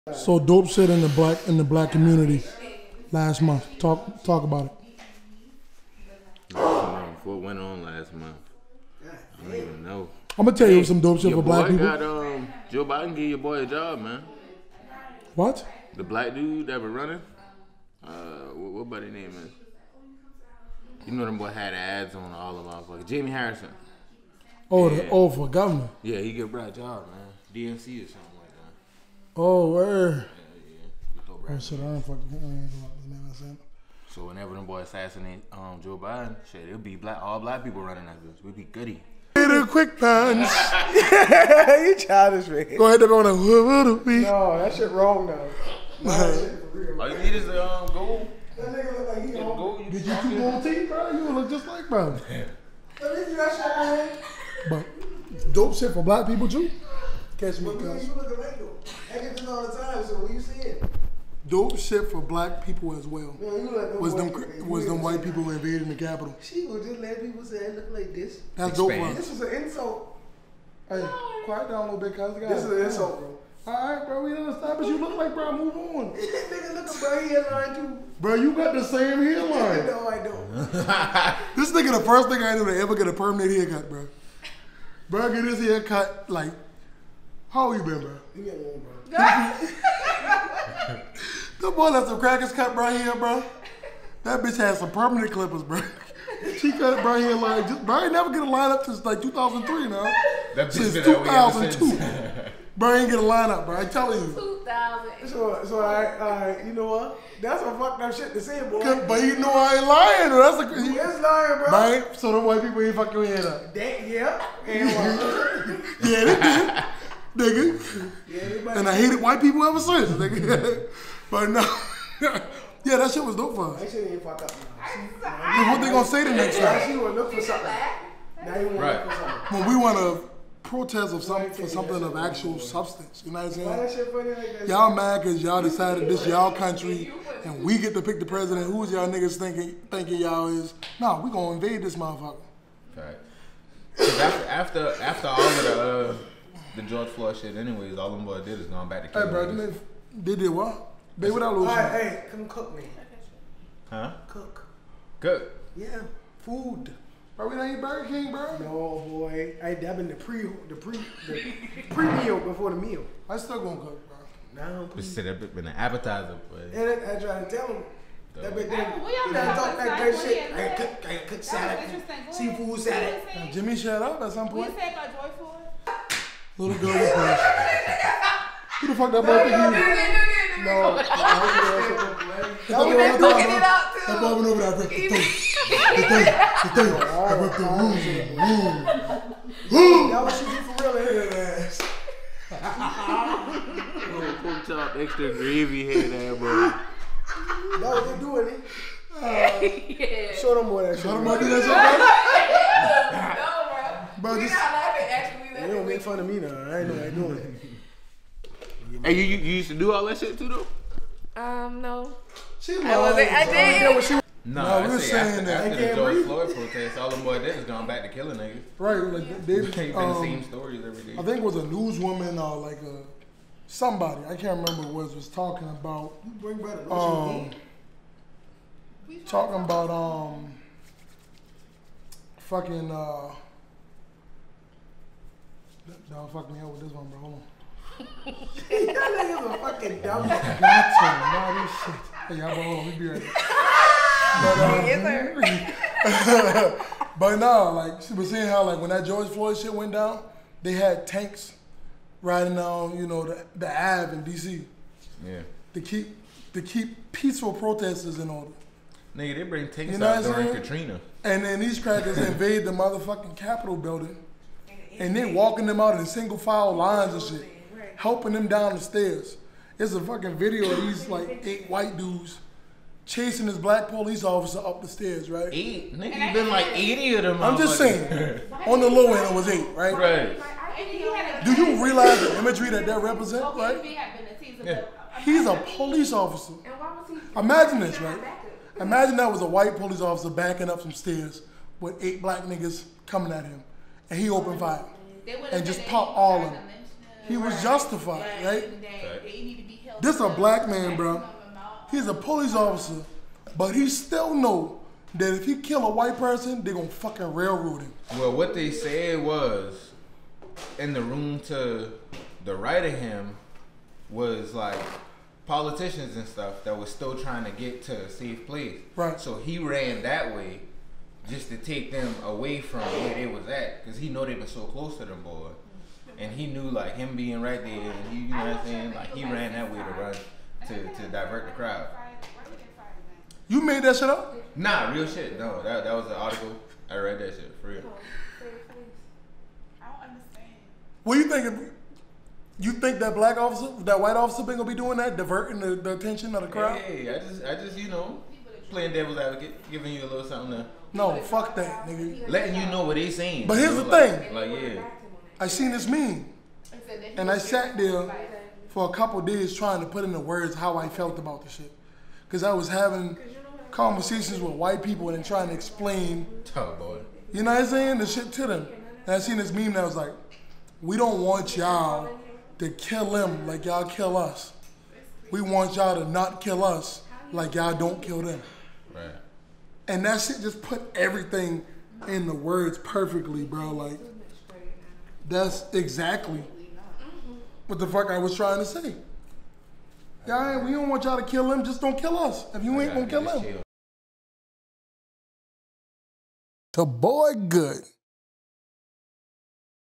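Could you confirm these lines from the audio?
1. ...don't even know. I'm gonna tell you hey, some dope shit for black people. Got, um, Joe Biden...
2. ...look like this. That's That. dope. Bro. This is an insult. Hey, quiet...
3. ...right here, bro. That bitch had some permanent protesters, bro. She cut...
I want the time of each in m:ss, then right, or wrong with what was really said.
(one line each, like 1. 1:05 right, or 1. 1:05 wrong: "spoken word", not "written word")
1. 0:09 right
2. 1:07 wrong: "Expand", not "That"
3. 1:32 wrong: "clippers", not "protesters".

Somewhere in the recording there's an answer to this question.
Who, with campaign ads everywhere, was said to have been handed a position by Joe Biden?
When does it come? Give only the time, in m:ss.
0:23.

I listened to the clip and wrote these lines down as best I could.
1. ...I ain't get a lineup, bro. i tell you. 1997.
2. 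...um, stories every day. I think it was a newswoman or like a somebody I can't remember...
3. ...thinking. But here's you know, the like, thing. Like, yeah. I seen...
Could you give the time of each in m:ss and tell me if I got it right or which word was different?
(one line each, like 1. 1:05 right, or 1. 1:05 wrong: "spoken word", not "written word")
1. 1:42 wrong: "2000", not "1997"
2. 3:40 right
3. 5:53 wrong: "saying", not "thinking".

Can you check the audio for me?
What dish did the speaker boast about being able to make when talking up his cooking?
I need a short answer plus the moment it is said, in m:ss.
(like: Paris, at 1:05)
Seafood salad, at 2:52.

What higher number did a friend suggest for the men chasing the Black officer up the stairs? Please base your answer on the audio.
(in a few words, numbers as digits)
80.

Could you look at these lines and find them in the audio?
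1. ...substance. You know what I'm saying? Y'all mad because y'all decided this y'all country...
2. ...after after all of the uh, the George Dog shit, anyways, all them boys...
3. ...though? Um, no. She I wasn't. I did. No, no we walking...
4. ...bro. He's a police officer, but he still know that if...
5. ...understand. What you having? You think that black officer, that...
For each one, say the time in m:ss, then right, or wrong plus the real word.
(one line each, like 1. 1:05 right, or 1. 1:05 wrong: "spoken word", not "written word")
1. 2:12 right
2. 2:24 wrong: "Floyd", not "Dog"
3. 3:30 wrong: "saying", not "walking"
4. 5:00 right
5. 5:40 wrong: "thinking", not "having".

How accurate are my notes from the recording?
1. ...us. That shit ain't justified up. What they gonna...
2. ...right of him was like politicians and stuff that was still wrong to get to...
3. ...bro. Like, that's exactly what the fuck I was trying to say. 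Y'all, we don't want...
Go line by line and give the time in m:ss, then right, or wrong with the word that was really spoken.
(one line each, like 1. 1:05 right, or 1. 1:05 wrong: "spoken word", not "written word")
1. 2:03 wrong: "fucked", not "justified"
2. 5:12 wrong: "trying", not "wrong"
3. 6:23 right.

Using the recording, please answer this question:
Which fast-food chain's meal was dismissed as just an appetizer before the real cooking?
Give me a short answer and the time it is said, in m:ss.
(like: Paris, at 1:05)
Burger King, at 2:37.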